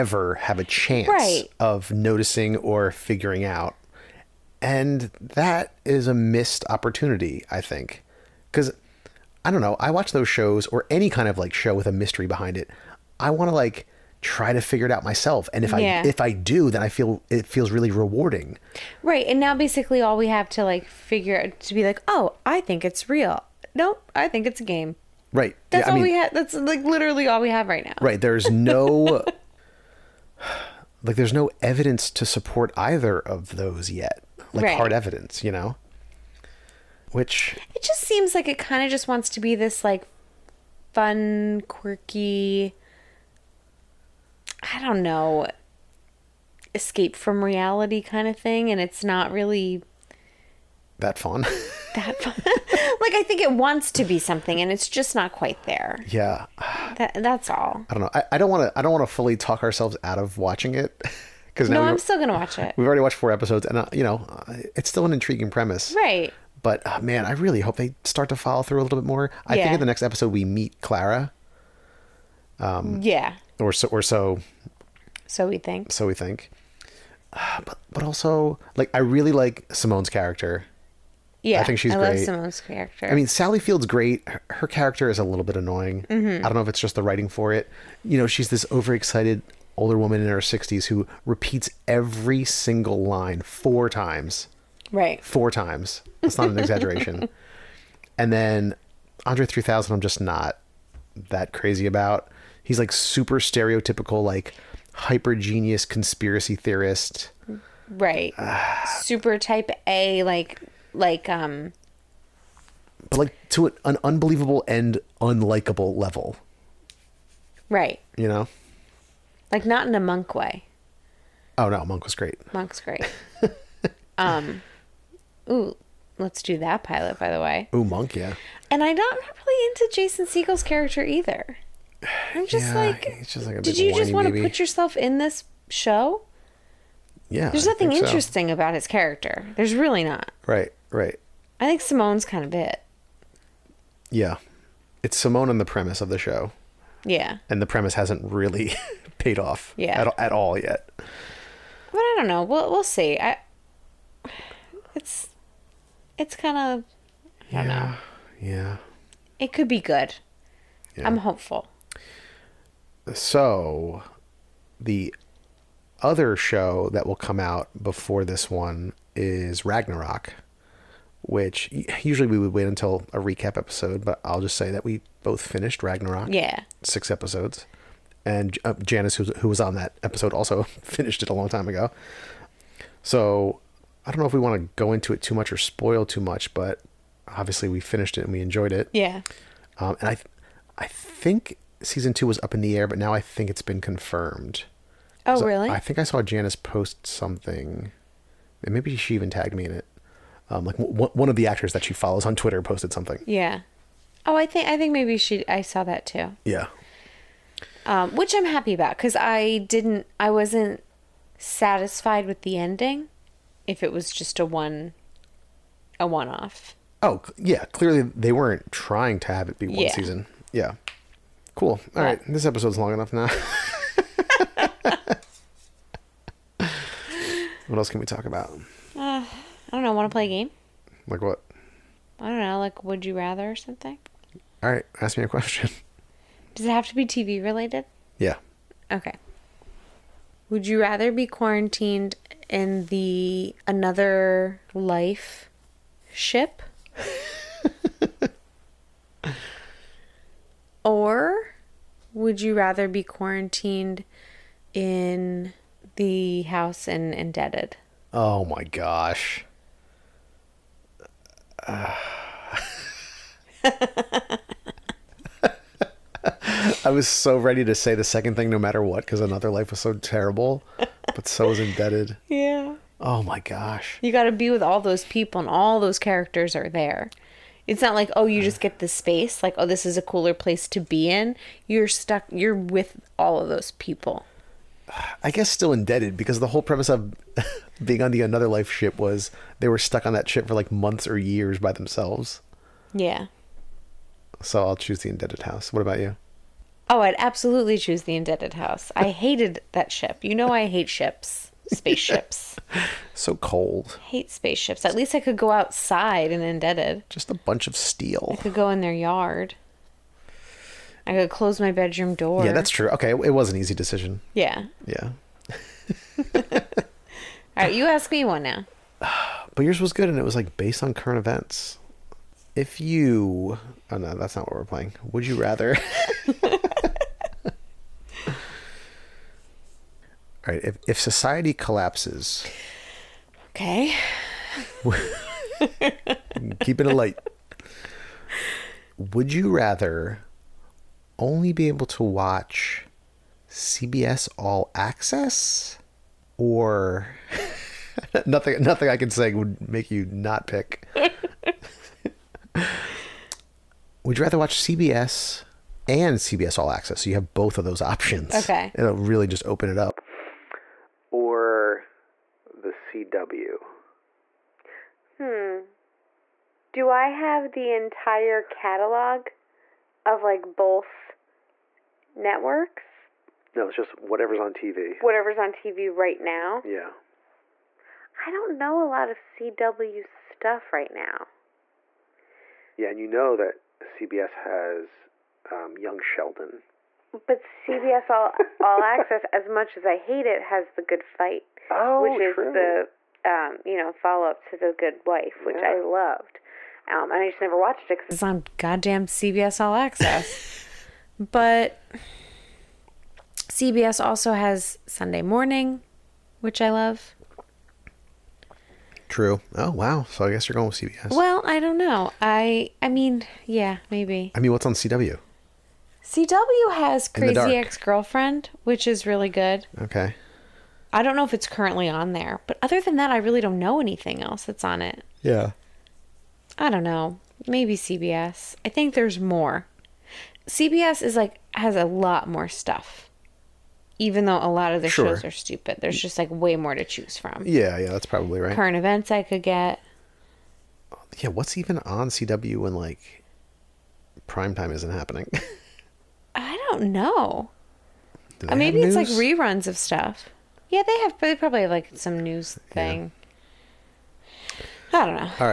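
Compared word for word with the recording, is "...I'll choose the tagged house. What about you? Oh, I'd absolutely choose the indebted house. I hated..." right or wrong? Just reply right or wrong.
wrong.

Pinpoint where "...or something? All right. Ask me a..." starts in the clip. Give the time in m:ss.
3:53.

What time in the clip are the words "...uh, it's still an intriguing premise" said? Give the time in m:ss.
1:04.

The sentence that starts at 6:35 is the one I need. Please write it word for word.
I loved, um, and I just never watched it because it's on goddamn CBS All Access.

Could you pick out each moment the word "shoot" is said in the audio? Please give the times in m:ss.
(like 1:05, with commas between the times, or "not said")
not said.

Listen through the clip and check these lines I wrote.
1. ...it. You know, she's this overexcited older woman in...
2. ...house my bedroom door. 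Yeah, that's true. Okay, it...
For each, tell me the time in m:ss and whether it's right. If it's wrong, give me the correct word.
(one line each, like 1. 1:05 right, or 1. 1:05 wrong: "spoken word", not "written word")
1. 1:27 right
2. 5:11 wrong: "close", not "house".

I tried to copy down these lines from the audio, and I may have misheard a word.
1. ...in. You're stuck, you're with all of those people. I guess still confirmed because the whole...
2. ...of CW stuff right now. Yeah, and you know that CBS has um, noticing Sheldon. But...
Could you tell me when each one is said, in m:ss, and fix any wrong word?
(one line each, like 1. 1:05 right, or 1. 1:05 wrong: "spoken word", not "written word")
1. 4:41 wrong: "indebted", not "confirmed"
2. 6:19 wrong: "young", not "noticing".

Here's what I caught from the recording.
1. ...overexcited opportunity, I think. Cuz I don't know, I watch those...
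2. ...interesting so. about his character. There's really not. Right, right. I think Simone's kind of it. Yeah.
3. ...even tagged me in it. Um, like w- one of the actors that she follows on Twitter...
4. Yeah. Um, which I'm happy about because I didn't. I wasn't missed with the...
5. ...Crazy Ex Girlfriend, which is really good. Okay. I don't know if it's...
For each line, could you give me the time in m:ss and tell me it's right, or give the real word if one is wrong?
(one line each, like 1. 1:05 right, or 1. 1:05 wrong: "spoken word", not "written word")
1. 0:06 wrong: "missed", not "overexcited"
2. 2:17 right
3. 3:19 right
4. 3:26 wrong: "satisfied", not "missed"
5. 6:57 right.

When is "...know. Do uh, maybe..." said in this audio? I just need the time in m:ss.
7:26.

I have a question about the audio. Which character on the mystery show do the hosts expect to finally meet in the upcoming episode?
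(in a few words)
Clara.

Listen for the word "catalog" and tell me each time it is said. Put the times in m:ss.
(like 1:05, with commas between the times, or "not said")
6:08.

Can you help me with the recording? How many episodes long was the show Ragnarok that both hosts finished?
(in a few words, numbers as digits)
6.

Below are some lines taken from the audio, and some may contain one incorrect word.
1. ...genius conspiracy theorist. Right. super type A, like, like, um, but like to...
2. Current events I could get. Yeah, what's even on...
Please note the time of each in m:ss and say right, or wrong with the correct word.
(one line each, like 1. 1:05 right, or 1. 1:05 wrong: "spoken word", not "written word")
1. 1:45 right
2. 7:18 right.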